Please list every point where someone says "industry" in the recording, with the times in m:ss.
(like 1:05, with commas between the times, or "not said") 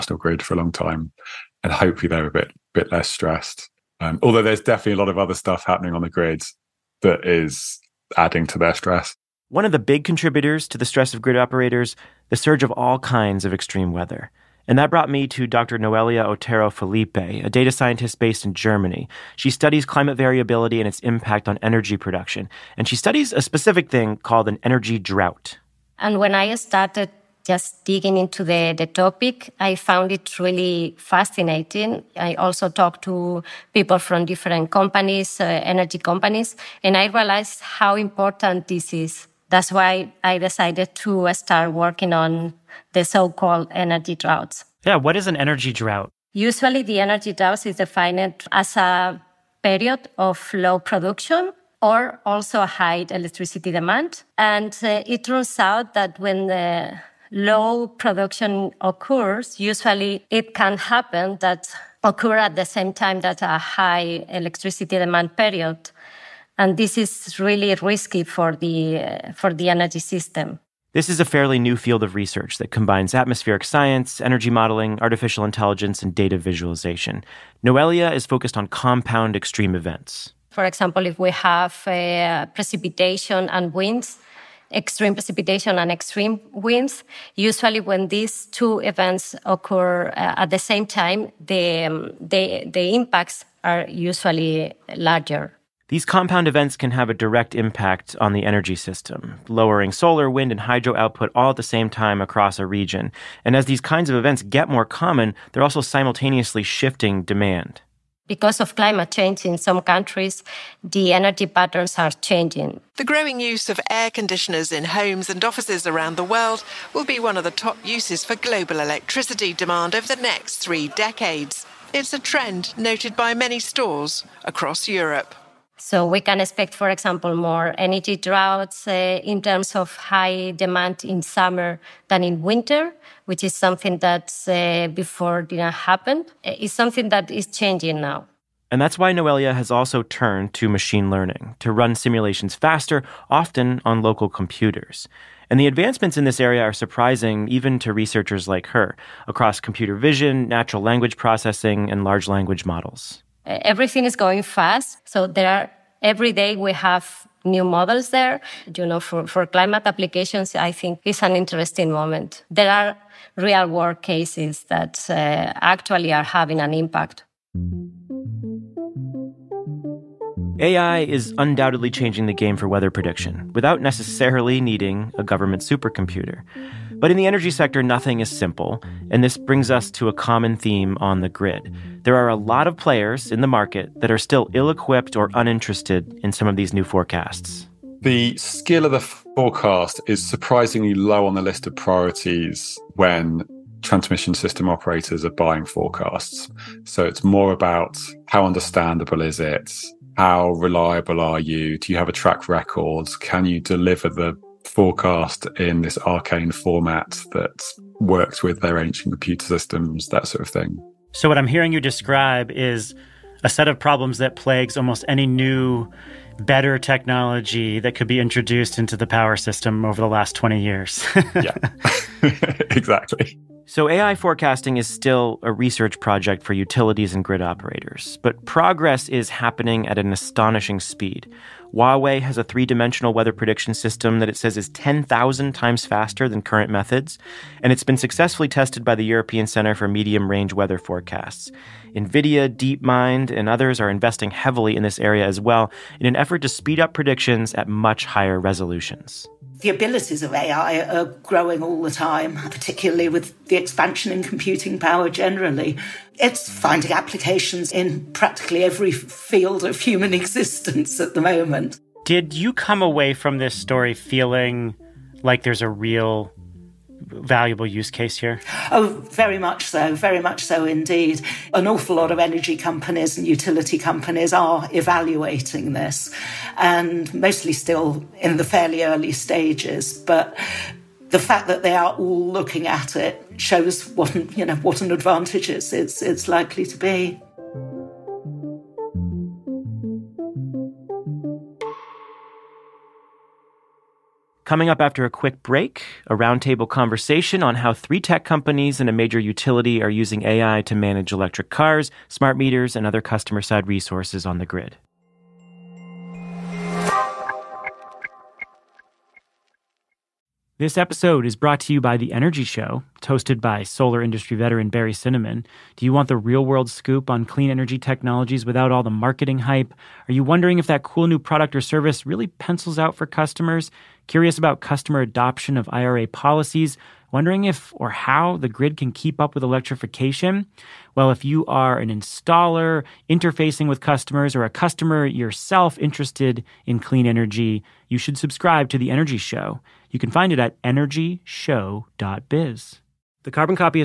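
5:14.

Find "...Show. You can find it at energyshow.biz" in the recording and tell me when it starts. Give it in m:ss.
5:39.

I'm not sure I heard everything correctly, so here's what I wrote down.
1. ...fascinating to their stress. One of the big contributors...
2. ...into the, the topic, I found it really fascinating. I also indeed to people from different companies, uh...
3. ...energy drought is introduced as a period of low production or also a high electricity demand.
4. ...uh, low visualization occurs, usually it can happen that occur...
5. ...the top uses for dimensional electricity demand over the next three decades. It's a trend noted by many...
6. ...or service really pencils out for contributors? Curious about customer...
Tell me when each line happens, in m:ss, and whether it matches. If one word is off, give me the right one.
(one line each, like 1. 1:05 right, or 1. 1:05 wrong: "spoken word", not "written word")
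1. 0:08 wrong: "adding", not "fascinating"
2. 0:28 wrong: "talked", not "indeed"
3. 0:47 wrong: "defined", not "introduced"
4. 0:56 wrong: "production", not "visualization"
5. 1:57 wrong: "global", not "dimensional"
6. 5:21 wrong: "customers", not "contributors".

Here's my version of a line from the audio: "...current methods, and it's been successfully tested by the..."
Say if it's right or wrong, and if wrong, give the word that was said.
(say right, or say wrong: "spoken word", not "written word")
right.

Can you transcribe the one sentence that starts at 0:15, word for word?
Noelia Otero Felipe, a data scientist based in Germany.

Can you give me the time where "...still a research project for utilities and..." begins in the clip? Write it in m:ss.
3:44.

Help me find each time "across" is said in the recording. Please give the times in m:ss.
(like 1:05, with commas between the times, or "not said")
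1:42, 2:04, 2:29.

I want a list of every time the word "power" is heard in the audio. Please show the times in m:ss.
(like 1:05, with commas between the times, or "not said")
3:39, 4:14.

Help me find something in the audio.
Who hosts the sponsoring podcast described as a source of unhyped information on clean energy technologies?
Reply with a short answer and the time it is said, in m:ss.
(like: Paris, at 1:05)
Barry Cinnamon, at 5:14.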